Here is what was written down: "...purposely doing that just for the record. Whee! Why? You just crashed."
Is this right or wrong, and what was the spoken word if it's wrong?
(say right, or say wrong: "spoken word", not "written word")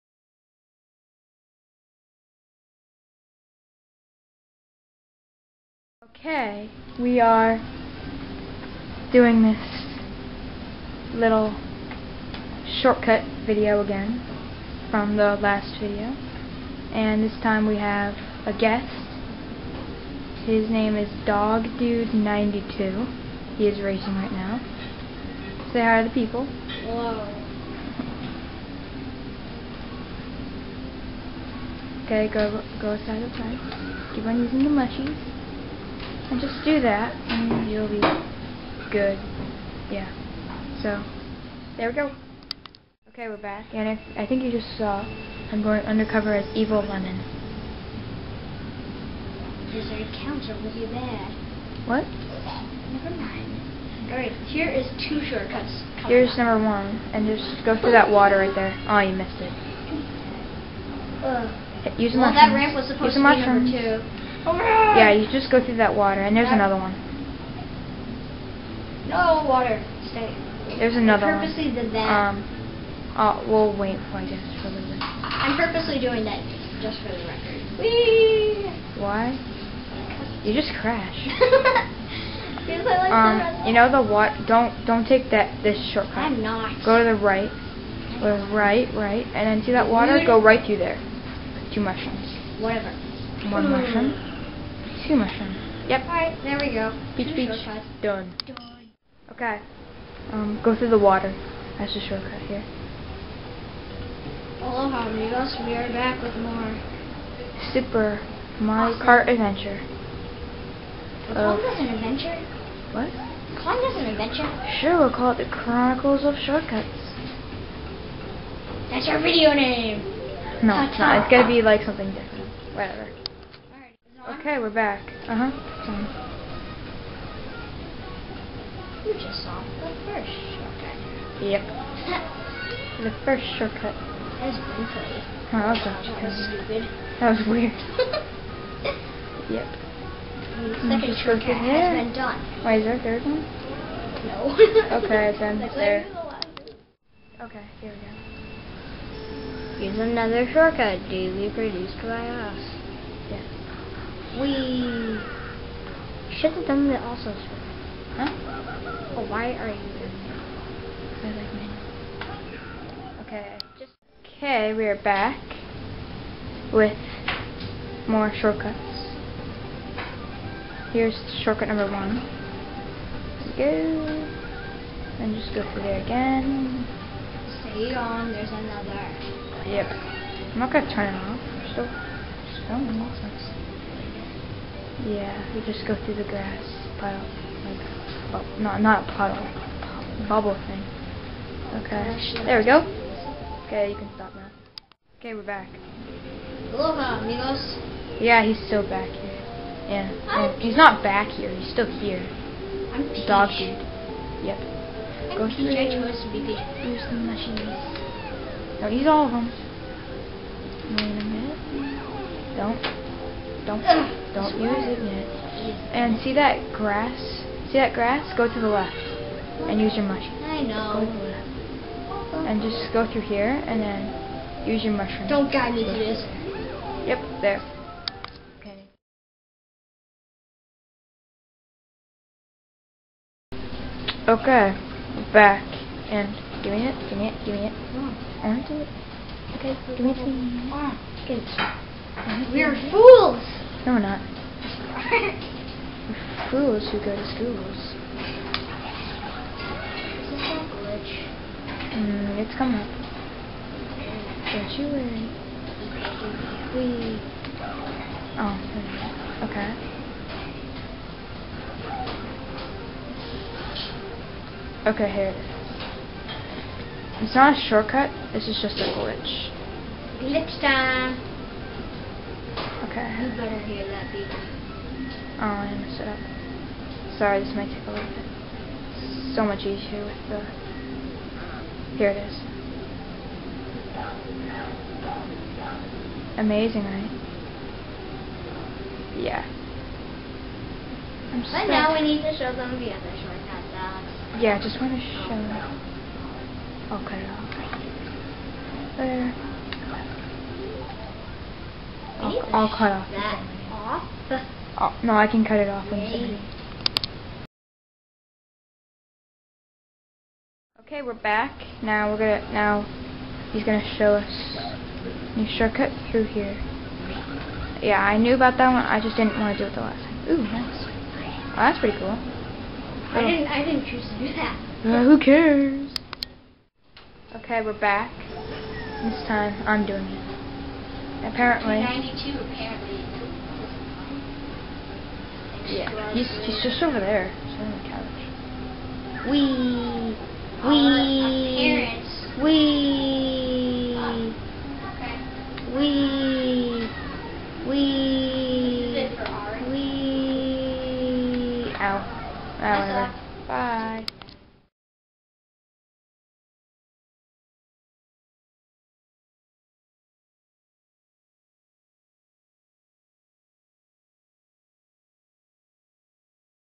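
right.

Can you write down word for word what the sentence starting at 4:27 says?
It's not a shortcut, this is just a glitch.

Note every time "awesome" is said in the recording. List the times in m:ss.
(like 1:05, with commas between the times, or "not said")
1:48.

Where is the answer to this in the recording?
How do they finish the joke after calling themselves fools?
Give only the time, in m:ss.
4:06.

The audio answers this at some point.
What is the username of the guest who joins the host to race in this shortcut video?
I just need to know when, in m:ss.
0:21.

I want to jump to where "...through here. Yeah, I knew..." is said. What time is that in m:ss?
5:16.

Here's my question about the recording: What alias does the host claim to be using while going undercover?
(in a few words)
Evil Lemon.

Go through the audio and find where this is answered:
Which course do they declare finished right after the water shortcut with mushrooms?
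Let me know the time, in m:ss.
1:37.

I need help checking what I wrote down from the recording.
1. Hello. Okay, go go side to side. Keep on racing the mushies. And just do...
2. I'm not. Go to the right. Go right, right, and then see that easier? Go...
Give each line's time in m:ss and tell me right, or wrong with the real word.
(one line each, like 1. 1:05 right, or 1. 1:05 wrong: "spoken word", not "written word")
1. 0:26 wrong: "using", not "racing"
2. 1:26 wrong: "water", not "easier".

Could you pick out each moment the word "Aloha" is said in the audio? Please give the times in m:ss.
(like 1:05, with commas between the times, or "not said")
1:44, 3:16.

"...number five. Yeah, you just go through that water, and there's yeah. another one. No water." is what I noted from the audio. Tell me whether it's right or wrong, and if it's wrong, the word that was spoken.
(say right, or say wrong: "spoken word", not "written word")
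wrong: "two", not "five".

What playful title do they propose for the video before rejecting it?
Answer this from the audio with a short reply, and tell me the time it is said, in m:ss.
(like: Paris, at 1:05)
the Chronicles of Shortcuts, at 1:55.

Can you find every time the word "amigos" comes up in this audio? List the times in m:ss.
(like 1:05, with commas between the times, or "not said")
1:45, 3:17.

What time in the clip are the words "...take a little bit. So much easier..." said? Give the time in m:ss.
4:37.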